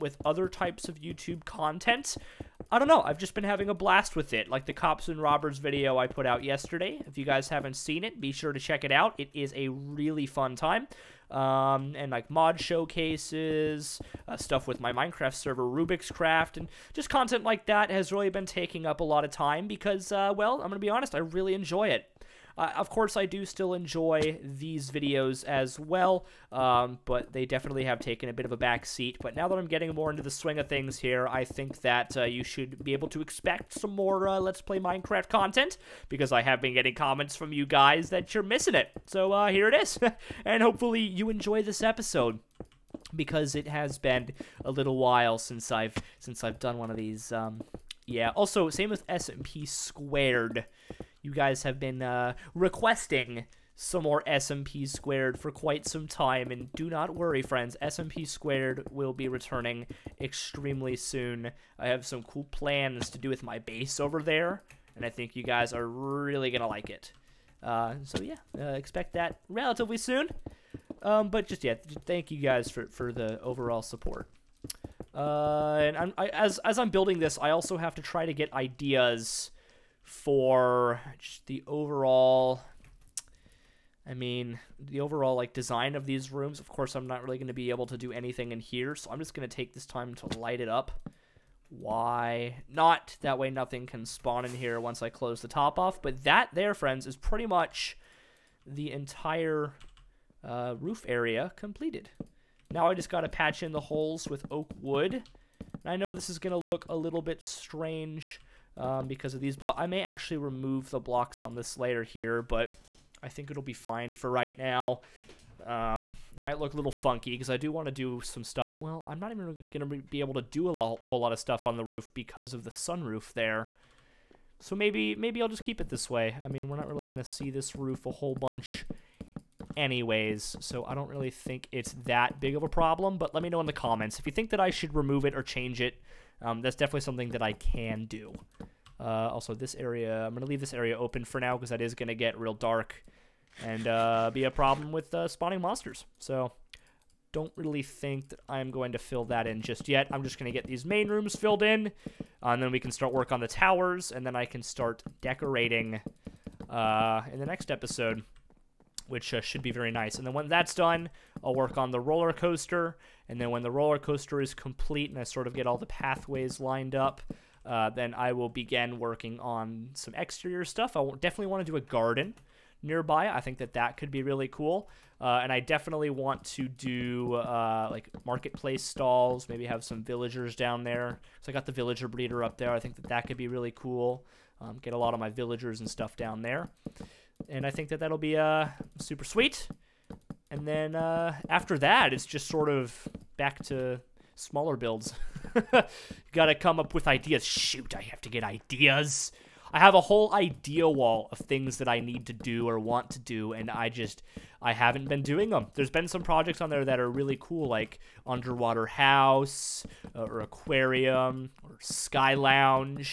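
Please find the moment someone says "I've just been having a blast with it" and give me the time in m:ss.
0:03.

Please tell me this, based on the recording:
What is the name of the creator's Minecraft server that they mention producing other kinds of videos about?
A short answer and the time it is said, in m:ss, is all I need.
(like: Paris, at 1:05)
Rubik's Craft, at 0:15.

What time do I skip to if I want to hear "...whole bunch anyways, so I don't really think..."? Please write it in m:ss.
2:08.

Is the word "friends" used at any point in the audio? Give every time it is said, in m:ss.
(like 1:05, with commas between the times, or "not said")
0:57, 1:36.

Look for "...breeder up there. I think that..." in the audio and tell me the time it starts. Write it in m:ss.
3:02.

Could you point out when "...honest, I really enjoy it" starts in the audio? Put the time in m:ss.
0:20.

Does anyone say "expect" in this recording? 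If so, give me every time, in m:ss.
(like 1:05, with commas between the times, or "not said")
0:33, 1:08.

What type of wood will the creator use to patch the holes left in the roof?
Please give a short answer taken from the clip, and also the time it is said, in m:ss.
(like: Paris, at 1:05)
Oak wood, at 1:44.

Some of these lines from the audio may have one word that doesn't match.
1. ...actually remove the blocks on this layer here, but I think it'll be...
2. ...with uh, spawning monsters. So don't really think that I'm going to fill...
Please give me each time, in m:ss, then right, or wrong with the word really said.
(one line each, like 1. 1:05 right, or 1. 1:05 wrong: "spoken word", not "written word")
1. 1:50 right
2. 2:24 right.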